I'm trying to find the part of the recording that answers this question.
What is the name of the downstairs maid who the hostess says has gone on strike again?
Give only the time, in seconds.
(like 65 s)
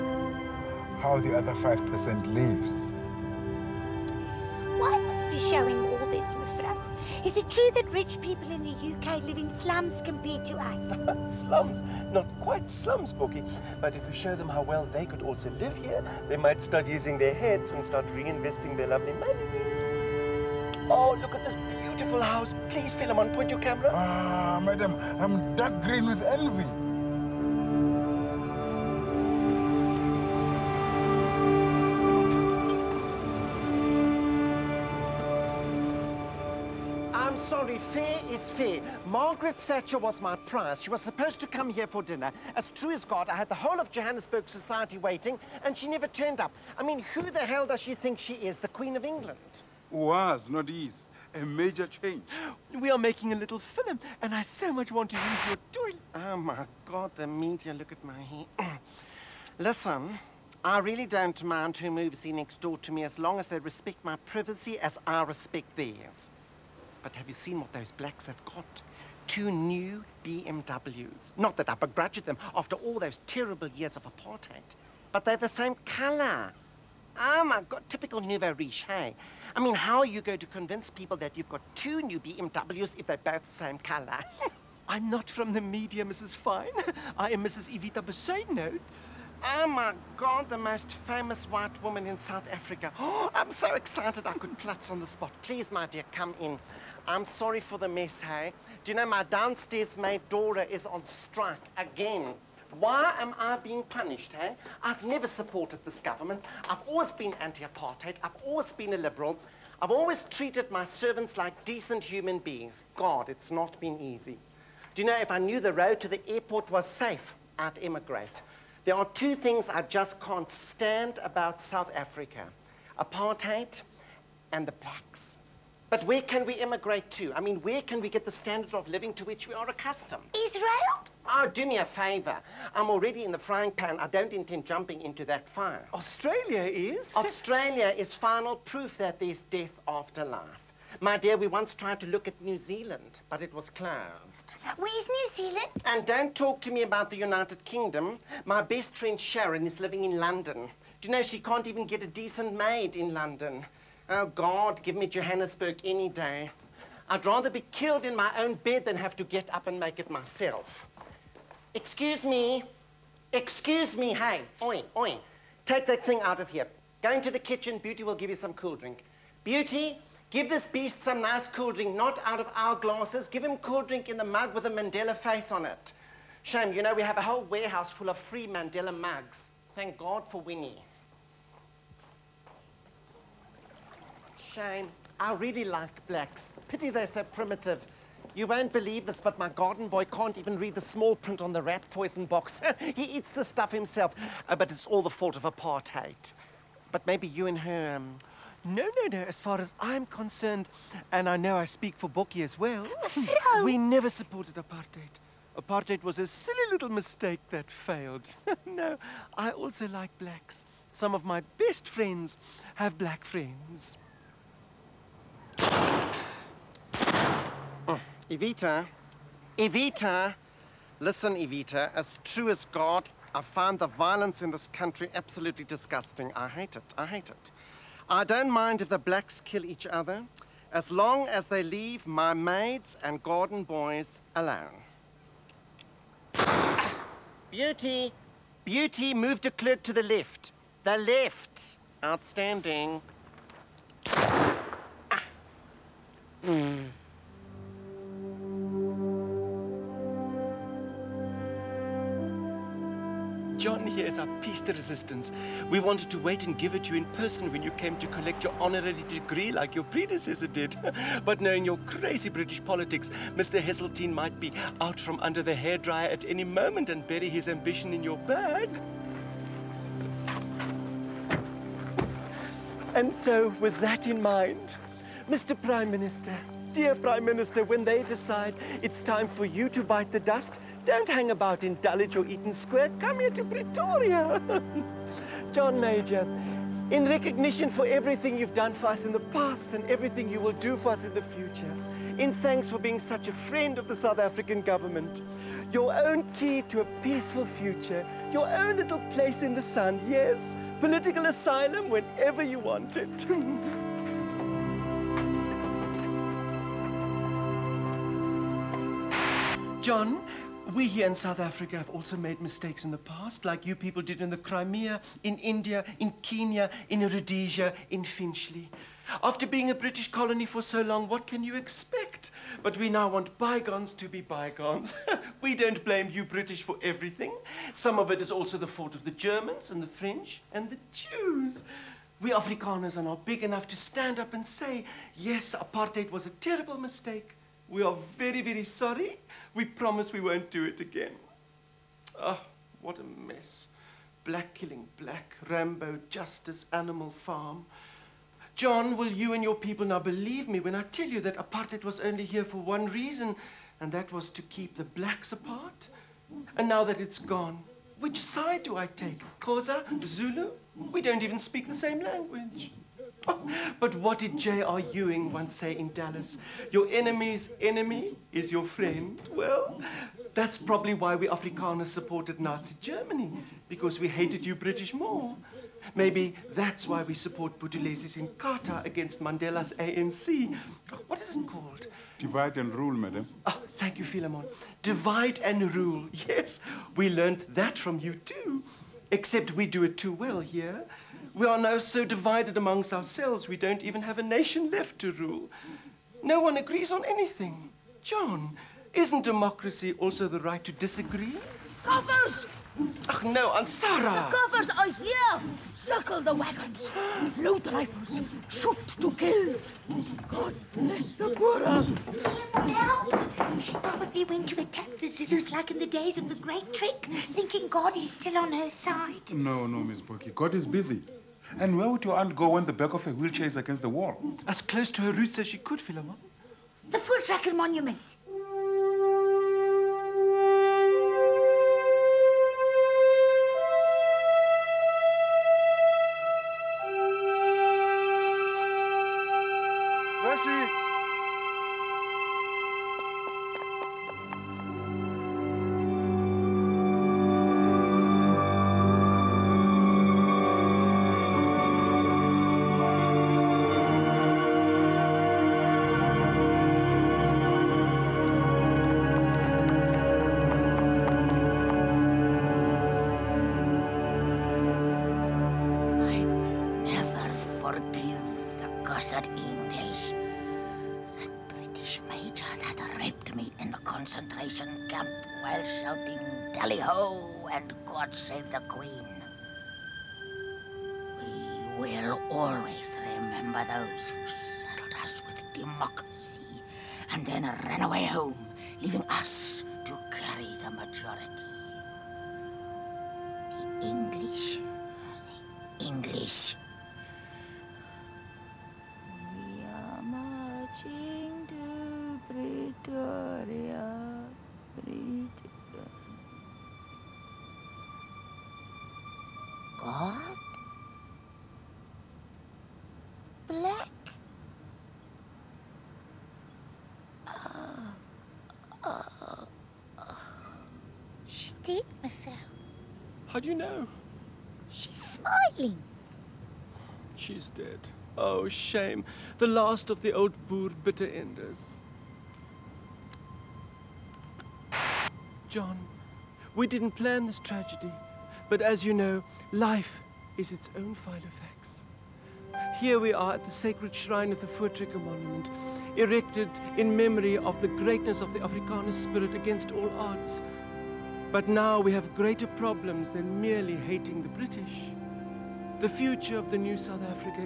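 100 s.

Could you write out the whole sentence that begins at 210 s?
Some of my best friends have black friends.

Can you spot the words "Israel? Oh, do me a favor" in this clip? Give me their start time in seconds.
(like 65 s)
130 s.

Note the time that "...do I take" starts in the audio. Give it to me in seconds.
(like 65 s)
358 s.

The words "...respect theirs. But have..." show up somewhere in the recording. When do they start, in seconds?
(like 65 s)
65 s.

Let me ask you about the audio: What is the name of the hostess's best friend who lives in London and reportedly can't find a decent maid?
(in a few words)
Sharon.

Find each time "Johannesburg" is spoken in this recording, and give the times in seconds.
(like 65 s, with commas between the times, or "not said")
43 s, 155 s.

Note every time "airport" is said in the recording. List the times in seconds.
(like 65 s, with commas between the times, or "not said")
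116 s.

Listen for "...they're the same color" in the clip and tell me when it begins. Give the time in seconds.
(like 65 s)
75 s.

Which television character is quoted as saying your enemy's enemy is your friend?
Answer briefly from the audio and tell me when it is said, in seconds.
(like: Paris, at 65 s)
J.R. Ewing, at 364 s.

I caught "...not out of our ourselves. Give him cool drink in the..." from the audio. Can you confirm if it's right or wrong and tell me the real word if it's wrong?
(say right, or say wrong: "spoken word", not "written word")
wrong: "glasses", not "ourselves".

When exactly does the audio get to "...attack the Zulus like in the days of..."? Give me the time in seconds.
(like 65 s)
414 s.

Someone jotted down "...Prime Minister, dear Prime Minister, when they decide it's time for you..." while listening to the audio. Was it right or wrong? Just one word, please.
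right.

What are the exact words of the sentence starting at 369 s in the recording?
Well, that's probably why we Afrikaners supported Nazi Germany, because we hated you British more.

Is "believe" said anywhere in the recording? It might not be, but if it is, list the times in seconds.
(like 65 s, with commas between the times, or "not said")
188 s, 350 s.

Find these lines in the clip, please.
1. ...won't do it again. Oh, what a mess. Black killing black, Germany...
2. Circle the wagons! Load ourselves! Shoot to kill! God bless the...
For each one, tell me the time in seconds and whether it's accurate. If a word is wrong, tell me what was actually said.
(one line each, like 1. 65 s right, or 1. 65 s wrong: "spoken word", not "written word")
1. 340 s wrong: "Rambo", not "Germany"
2. 405 s wrong: "rifles", not "ourselves".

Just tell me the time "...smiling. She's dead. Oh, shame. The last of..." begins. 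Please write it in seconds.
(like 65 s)
525 s.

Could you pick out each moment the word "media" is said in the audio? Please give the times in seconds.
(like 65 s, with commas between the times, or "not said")
57 s, 85 s.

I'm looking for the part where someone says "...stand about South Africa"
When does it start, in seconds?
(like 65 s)
120 s.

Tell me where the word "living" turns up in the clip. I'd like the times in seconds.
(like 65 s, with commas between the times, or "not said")
128 s, 149 s.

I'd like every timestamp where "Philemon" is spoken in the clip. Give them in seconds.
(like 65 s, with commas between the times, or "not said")
22 s, 384 s, 425 s.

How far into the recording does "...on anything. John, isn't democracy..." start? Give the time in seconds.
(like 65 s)
396 s.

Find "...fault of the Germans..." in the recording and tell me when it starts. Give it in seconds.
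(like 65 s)
328 s.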